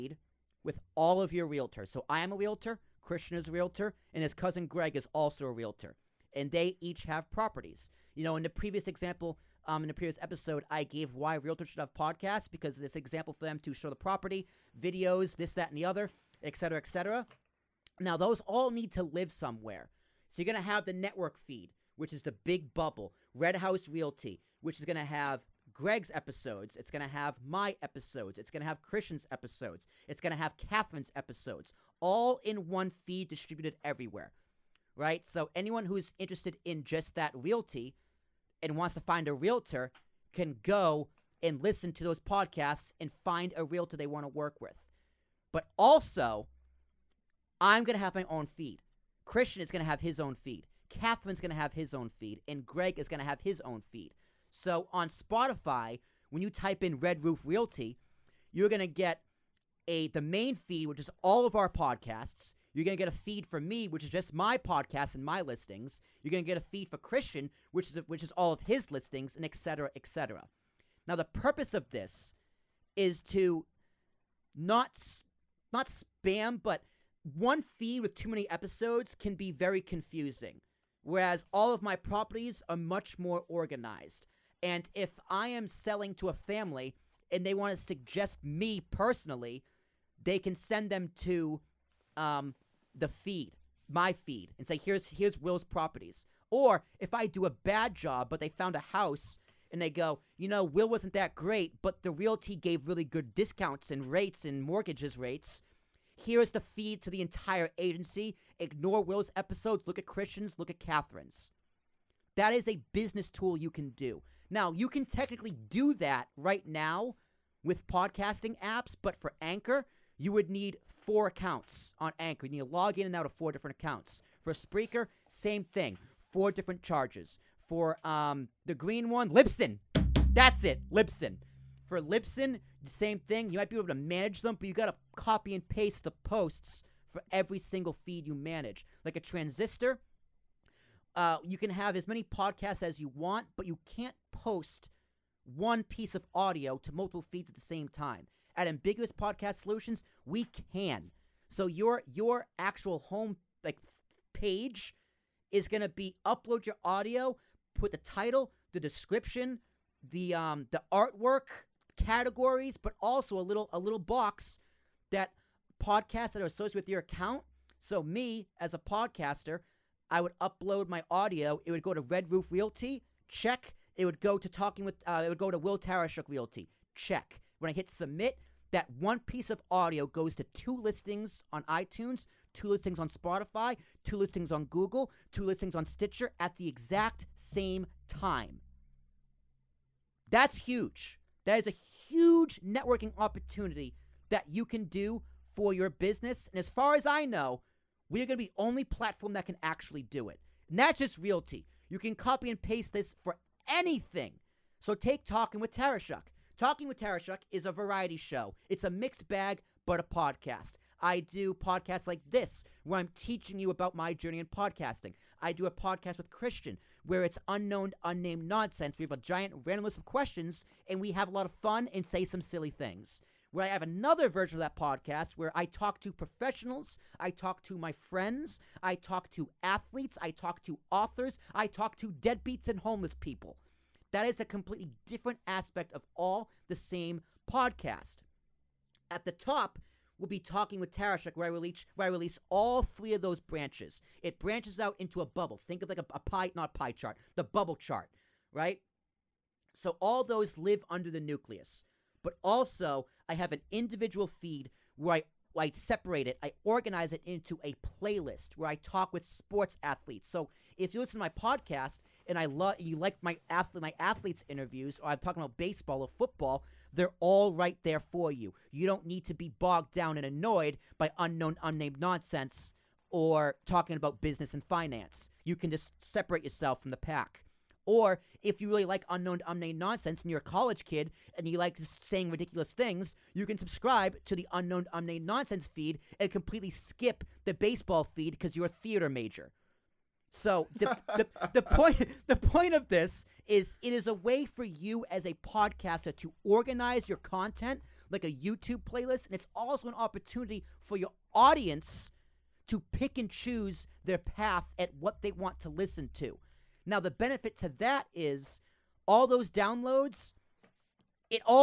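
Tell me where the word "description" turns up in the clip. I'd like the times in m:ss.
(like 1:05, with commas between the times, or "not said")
2:38.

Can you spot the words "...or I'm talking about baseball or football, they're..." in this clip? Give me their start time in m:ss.
4:25.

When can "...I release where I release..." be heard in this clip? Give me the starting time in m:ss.
4:01.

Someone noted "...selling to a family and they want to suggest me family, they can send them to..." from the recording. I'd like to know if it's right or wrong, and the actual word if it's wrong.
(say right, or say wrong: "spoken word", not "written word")
wrong: "personally", not "family".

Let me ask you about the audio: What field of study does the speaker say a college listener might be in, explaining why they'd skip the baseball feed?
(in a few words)
Theater.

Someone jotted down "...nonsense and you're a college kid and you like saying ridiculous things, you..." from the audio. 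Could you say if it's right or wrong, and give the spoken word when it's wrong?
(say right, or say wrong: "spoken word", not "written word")
right.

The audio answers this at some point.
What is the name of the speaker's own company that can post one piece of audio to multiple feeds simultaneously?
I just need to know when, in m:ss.
2:28.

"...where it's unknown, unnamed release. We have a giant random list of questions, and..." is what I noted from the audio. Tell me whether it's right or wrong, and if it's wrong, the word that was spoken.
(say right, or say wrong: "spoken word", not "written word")
wrong: "nonsense", not "release".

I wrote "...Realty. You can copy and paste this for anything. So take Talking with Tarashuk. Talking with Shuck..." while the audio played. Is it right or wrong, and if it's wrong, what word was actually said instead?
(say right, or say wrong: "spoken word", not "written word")
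right.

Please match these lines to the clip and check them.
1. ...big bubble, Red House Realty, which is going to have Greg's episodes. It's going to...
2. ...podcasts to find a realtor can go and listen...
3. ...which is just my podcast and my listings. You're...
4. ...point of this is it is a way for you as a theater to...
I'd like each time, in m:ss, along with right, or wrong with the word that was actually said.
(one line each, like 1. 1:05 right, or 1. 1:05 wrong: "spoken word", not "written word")
1. 0:22 right
2. 0:38 wrong: "wants", not "podcasts"
3. 1:03 right
4. 4:52 wrong: "podcaster", not "theater".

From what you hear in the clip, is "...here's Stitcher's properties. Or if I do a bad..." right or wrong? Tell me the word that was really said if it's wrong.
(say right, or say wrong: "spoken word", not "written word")
wrong: "Will", not "Stitcher".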